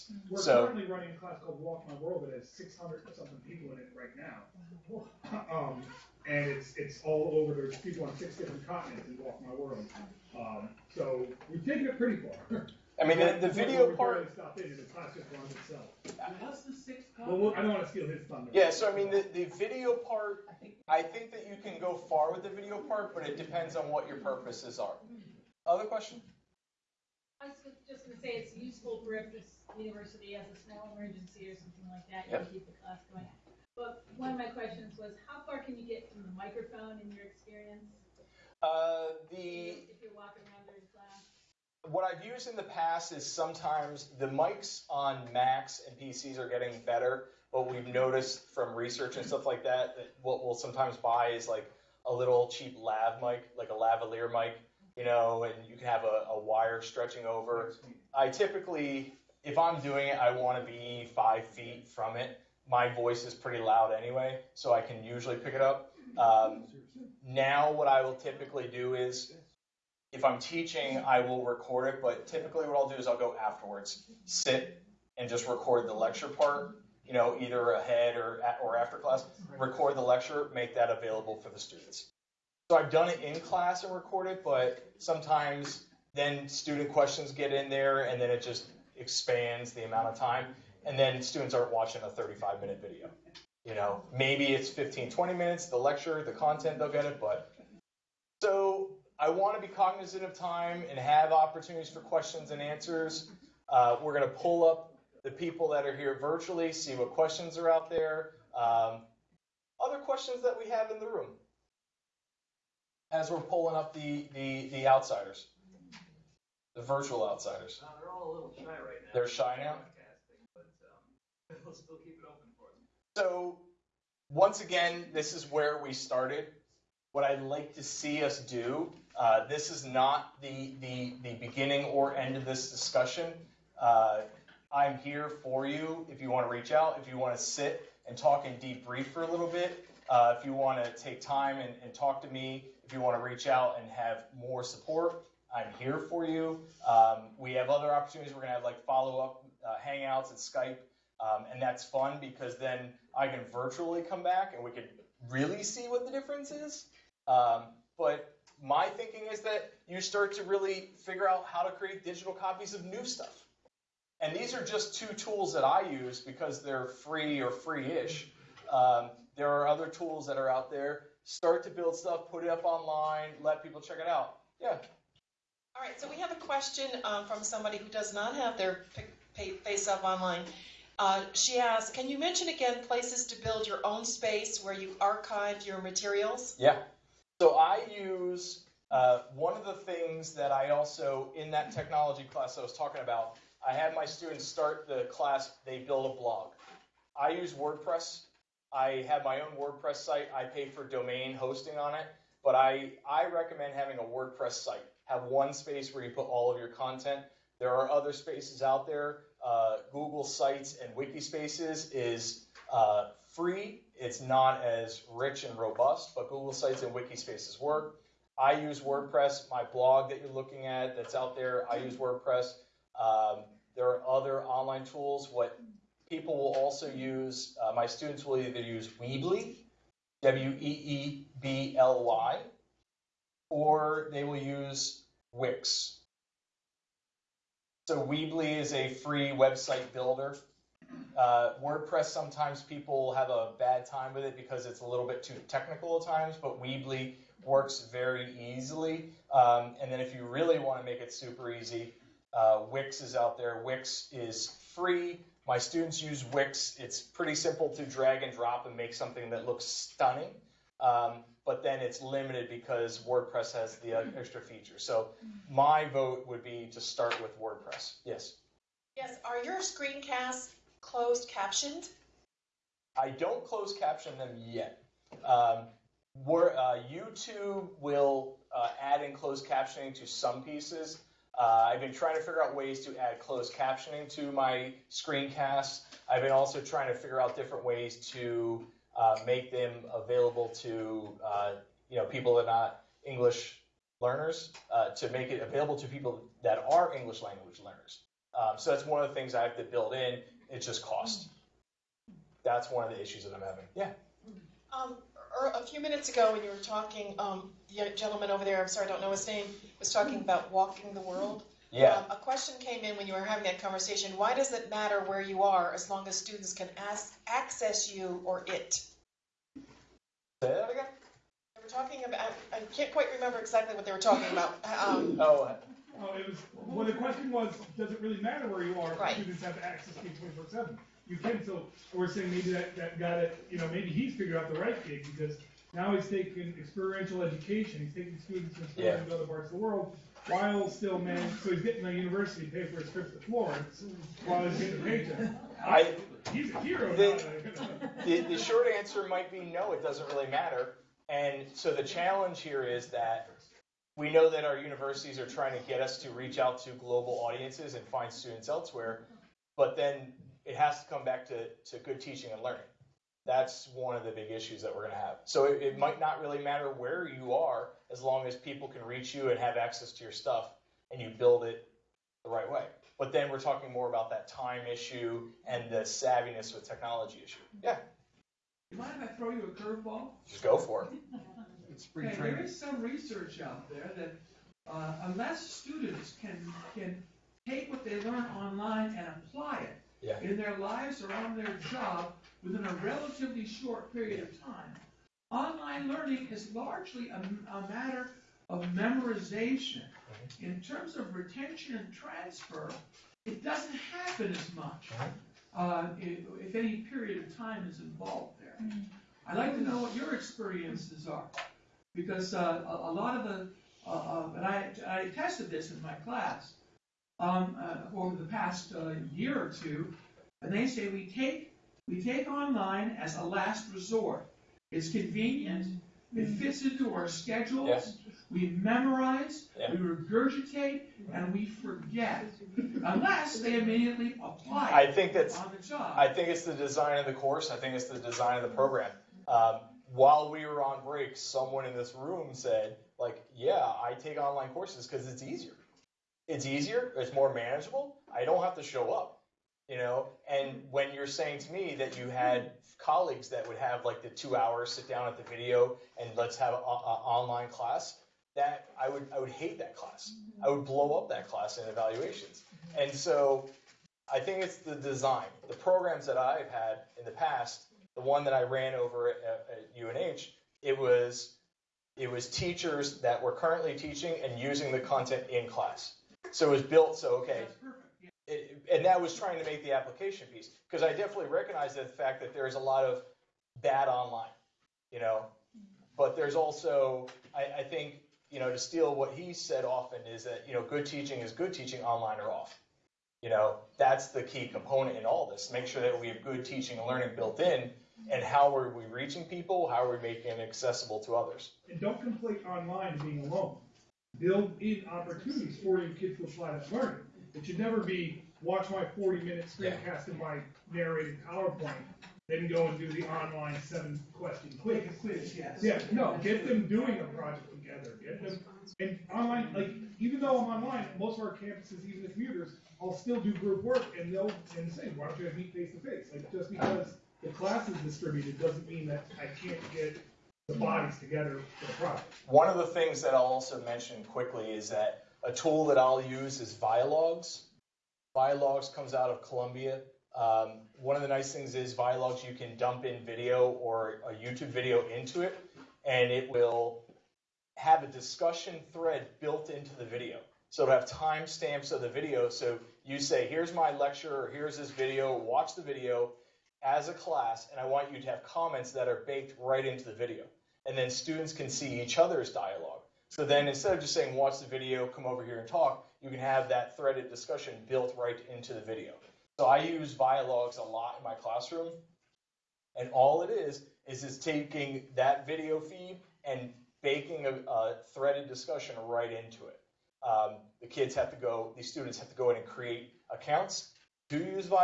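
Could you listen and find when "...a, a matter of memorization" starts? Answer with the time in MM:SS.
06:37.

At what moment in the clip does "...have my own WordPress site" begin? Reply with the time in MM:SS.
03:19.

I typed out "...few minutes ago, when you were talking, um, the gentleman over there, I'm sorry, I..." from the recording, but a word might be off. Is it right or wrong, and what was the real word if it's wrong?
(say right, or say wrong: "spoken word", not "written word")
right.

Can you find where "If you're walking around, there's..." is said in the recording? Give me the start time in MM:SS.
00:39.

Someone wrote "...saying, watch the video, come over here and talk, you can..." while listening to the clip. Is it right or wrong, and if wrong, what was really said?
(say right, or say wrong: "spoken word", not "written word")
right.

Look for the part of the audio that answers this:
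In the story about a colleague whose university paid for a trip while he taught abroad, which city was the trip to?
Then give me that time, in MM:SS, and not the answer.
05:43.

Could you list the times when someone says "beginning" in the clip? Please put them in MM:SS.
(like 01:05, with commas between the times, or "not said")
02:11.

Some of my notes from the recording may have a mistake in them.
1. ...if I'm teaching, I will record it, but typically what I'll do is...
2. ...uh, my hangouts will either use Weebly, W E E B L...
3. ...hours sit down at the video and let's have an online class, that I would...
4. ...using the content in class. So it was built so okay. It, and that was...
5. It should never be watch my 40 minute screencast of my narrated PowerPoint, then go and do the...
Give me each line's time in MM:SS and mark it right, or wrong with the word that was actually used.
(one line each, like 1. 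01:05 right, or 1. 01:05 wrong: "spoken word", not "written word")
1. 01:10 right
2. 03:47 wrong: "students", not "hangouts"
3. 07:34 right
4. 07:54 right
5. 08:27 right.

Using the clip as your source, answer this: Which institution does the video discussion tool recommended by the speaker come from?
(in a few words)
Columbia.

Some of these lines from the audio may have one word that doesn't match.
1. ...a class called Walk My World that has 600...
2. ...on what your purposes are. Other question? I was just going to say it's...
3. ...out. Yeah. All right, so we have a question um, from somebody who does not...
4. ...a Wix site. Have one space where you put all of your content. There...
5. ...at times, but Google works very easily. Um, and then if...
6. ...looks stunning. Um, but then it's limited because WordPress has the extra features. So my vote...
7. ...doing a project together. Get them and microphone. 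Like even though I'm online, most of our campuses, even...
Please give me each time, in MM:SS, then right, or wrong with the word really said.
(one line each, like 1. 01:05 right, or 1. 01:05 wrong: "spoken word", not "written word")
1. 00:01 right
2. 00:23 right
3. 02:54 right
4. 03:23 wrong: "WordPress", not "Wix"
5. 04:06 wrong: "Weebly", not "Google"
6. 04:19 right
7. 08:36 wrong: "online", not "microphone".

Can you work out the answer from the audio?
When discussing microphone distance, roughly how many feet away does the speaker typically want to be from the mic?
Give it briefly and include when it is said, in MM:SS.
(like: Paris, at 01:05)
5 feet, at 01:01.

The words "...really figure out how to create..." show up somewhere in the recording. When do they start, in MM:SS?
02:40.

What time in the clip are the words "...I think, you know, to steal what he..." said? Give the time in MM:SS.
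08:07.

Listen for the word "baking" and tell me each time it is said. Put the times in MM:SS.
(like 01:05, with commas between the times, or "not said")
09:36.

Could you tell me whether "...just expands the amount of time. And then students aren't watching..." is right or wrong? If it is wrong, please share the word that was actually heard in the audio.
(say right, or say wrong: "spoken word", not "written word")
right.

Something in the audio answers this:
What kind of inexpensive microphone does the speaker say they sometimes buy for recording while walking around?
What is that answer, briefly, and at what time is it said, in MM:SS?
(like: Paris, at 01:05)
lavalier mic, at 00:53.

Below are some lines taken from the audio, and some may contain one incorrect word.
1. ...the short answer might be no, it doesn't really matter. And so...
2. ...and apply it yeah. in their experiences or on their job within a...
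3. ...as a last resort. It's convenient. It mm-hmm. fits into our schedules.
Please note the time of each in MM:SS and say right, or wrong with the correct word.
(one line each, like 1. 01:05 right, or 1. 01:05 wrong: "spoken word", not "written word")
1. 05:48 right
2. 06:28 wrong: "lives", not "experiences"
3. 07:03 right.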